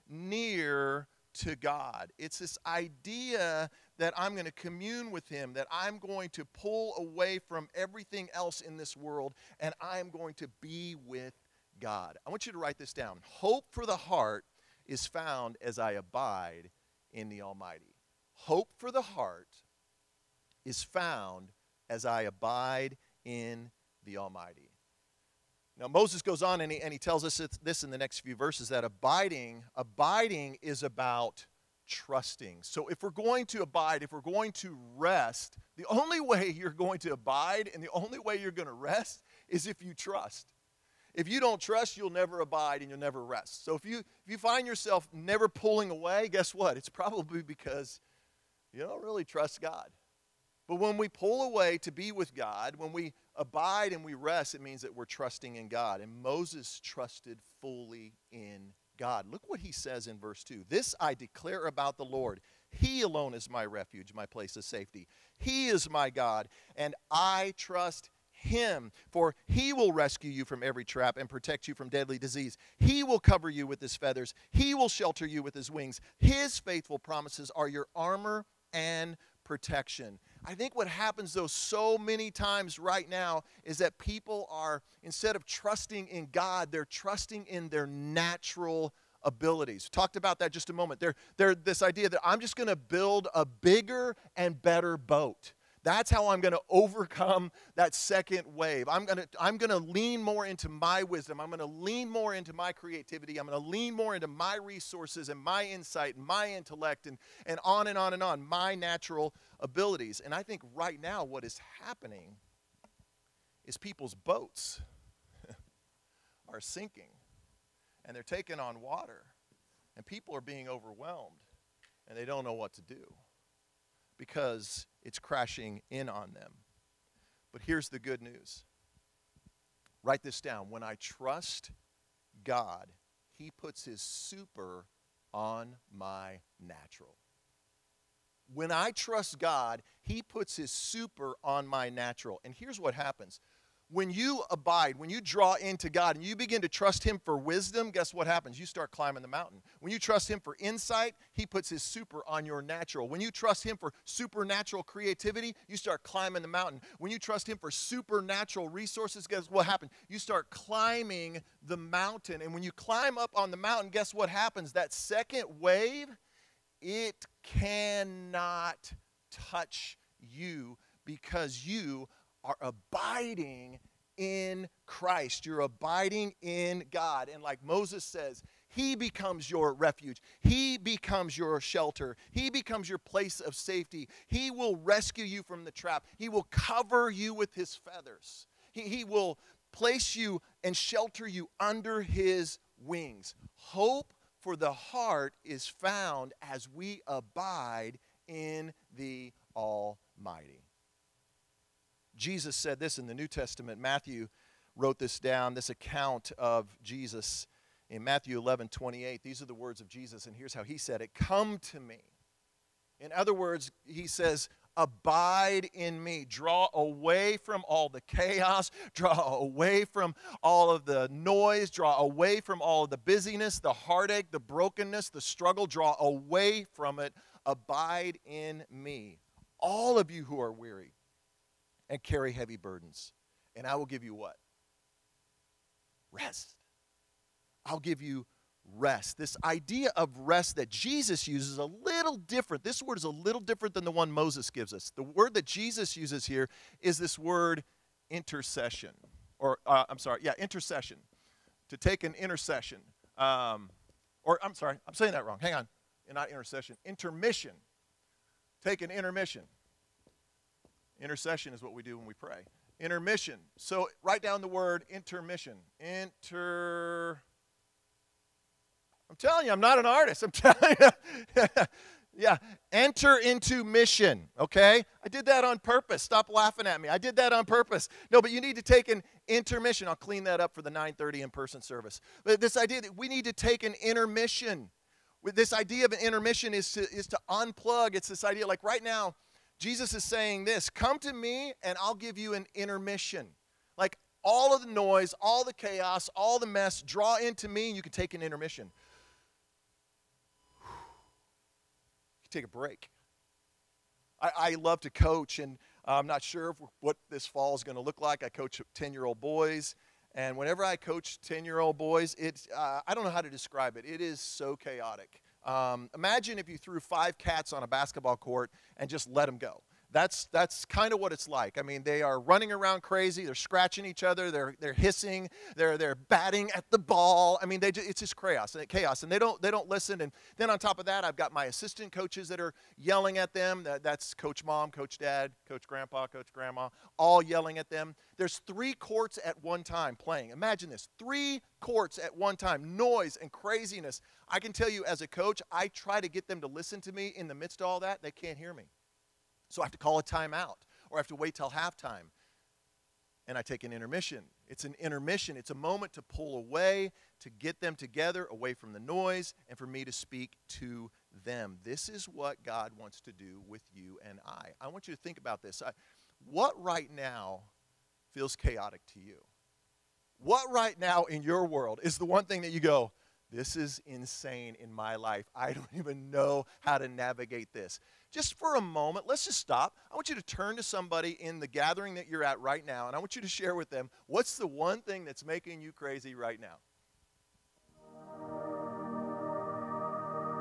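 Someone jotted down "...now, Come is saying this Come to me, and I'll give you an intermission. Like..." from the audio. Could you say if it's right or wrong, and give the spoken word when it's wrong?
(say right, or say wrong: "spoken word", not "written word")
wrong: "Jesus", not "Come".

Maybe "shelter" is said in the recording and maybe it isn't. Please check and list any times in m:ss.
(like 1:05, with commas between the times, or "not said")
1:14, 3:01, 3:10.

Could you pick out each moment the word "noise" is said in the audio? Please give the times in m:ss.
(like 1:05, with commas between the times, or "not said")
3:41, 4:54, 5:42, 5:58.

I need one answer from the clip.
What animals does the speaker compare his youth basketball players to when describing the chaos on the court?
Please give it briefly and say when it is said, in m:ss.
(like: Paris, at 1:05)
Cats, at 5:17.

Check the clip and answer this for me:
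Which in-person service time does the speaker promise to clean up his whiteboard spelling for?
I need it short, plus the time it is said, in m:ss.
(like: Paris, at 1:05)
9:30, at 4:40.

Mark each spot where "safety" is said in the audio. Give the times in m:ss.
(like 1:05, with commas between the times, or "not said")
1:04, 3:03.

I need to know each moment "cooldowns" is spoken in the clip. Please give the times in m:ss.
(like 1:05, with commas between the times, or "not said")
not said.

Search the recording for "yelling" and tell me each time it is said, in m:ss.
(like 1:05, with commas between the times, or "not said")
5:32, 5:37.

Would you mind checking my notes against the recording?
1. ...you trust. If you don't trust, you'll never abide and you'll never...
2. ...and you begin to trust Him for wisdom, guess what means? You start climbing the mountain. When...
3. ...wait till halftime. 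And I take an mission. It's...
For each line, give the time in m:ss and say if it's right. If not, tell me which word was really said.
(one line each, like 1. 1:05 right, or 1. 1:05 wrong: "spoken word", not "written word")
1. 0:39 right
2. 2:26 wrong: "happens", not "means"
3. 5:51 wrong: "intermission", not "mission".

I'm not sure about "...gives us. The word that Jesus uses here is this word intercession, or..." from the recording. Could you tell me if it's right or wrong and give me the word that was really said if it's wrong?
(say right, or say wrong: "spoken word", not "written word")
right.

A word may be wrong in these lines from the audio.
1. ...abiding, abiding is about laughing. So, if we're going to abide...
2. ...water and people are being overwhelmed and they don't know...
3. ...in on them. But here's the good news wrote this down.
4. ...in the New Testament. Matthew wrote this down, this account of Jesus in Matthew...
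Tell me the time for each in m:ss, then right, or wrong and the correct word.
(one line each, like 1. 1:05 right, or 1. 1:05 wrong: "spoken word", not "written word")
1. 0:28 wrong: "trusting", not "laughing"
2. 1:58 right
3. 2:05 wrong: "write", not "wrote"
4. 3:22 right.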